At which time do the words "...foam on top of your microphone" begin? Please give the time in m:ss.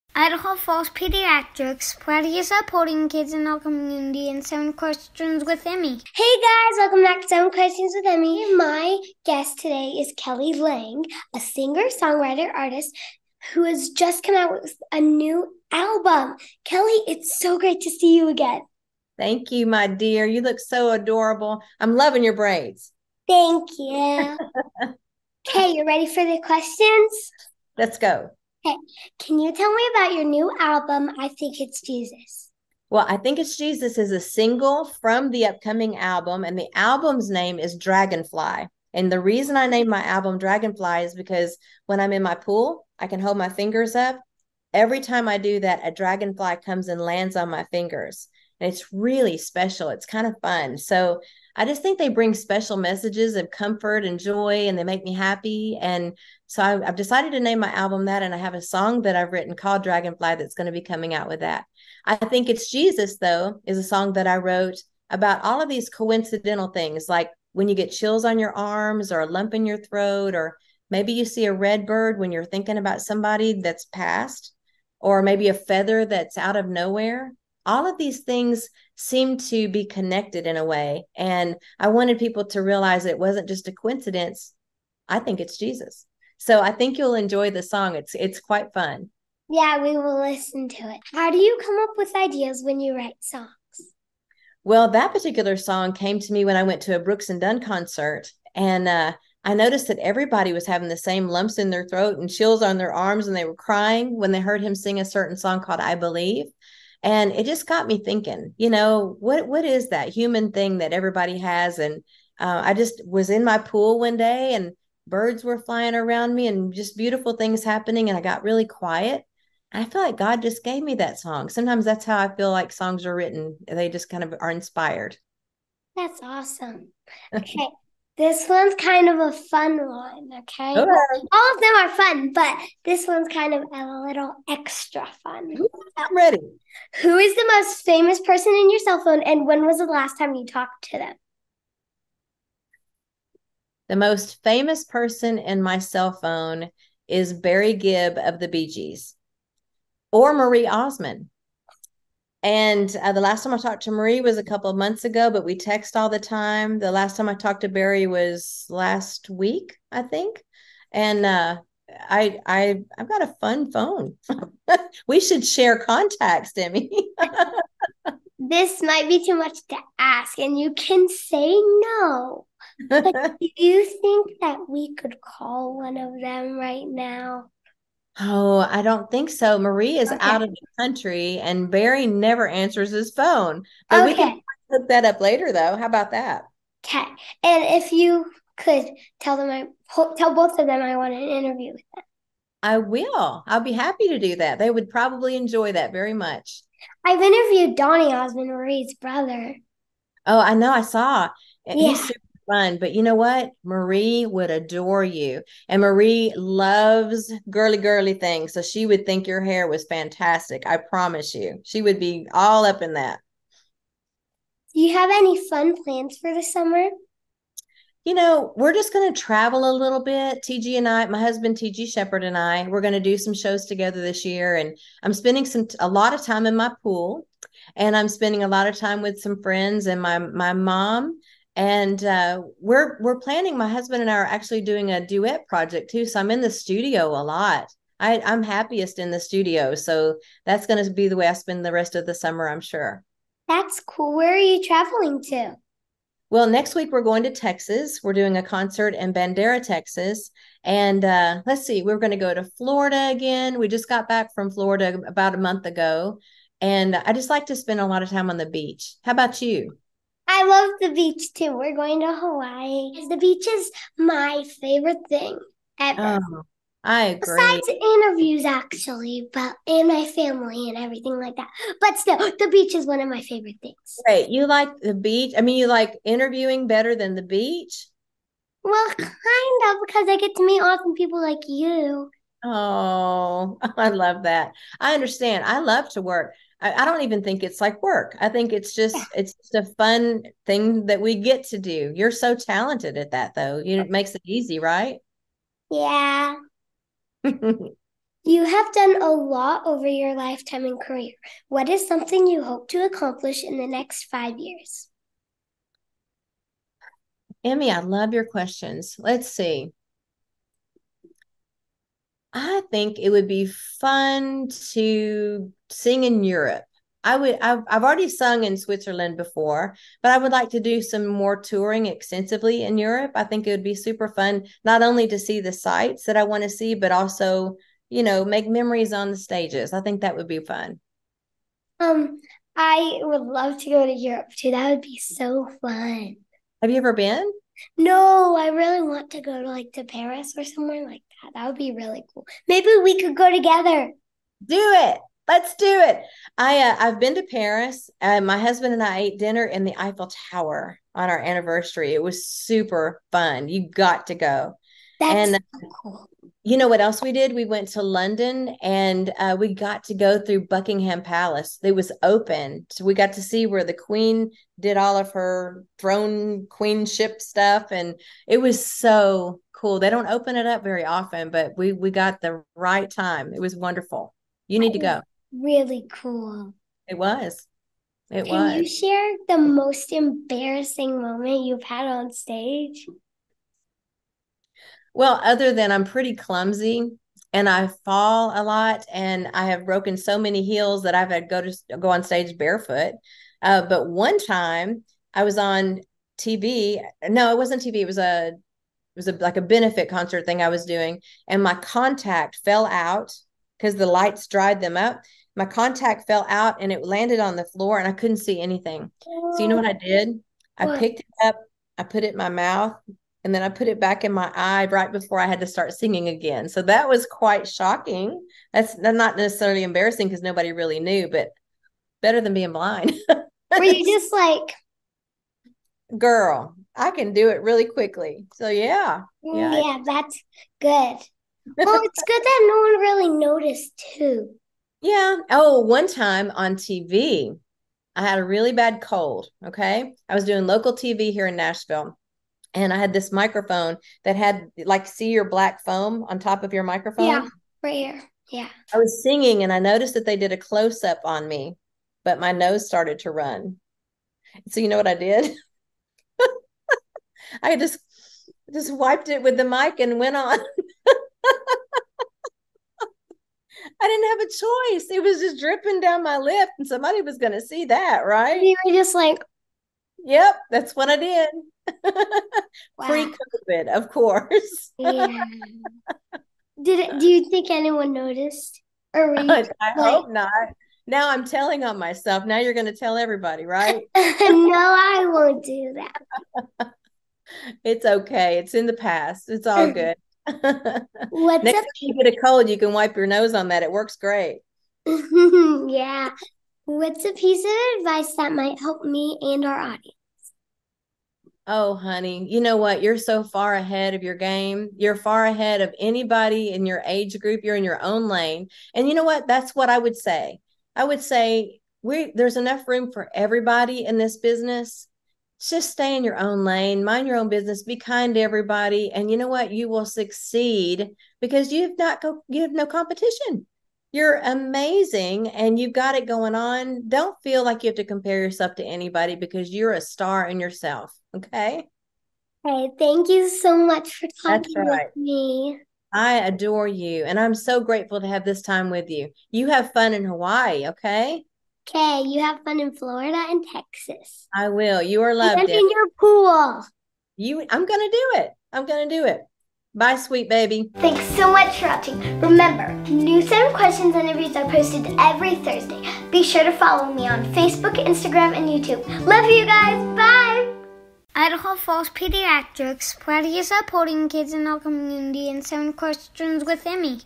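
7:25.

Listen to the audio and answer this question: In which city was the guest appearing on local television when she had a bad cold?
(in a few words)
Nashville.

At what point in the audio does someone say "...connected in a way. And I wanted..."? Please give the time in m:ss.
1:19.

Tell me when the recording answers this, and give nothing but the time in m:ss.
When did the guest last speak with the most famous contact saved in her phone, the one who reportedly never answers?
2:38.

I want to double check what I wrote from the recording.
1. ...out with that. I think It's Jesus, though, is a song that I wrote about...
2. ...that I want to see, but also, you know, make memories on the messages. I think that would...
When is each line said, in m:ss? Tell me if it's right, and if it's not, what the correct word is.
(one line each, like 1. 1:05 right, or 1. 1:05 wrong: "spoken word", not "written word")
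1. 1:01 right
2. 5:26 wrong: "stages", not "messages".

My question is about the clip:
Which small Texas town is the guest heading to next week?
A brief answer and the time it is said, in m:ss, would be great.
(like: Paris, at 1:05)
Bandera, at 4:09.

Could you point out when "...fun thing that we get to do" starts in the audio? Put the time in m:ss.
4:49.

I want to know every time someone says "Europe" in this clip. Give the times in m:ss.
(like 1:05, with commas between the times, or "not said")
5:16, 5:22, 5:33.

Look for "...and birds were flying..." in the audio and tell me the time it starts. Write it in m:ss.
1:54.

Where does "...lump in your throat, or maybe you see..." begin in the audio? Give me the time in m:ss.
1:09.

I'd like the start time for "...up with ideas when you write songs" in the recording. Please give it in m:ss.
1:31.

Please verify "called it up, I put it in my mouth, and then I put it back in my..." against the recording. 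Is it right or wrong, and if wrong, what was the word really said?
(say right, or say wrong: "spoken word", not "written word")
wrong: "picked", not "called".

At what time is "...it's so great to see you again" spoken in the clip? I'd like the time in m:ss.
0:17.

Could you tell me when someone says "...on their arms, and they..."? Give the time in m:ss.
1:42.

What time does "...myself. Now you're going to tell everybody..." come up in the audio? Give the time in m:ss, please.
8:01.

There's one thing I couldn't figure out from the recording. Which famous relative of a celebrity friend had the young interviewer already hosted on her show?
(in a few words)
Donny Osmond.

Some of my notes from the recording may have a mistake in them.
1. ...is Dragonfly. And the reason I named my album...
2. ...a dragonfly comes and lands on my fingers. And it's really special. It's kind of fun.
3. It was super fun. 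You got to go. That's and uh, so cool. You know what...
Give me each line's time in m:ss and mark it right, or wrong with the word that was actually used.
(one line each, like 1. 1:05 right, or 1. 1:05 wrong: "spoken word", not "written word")
1. 0:37 right
2. 0:45 right
3. 5:51 right.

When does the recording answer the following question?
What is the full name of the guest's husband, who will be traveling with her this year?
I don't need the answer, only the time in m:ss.
3:41.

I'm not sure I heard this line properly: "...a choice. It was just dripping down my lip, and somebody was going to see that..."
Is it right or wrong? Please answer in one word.
right.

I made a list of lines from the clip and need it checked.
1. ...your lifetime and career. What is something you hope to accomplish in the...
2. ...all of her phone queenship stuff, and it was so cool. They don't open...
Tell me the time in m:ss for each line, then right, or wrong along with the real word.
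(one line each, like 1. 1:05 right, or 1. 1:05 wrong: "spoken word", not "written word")
1. 4:59 right
2. 6:04 wrong: "throne", not "phone".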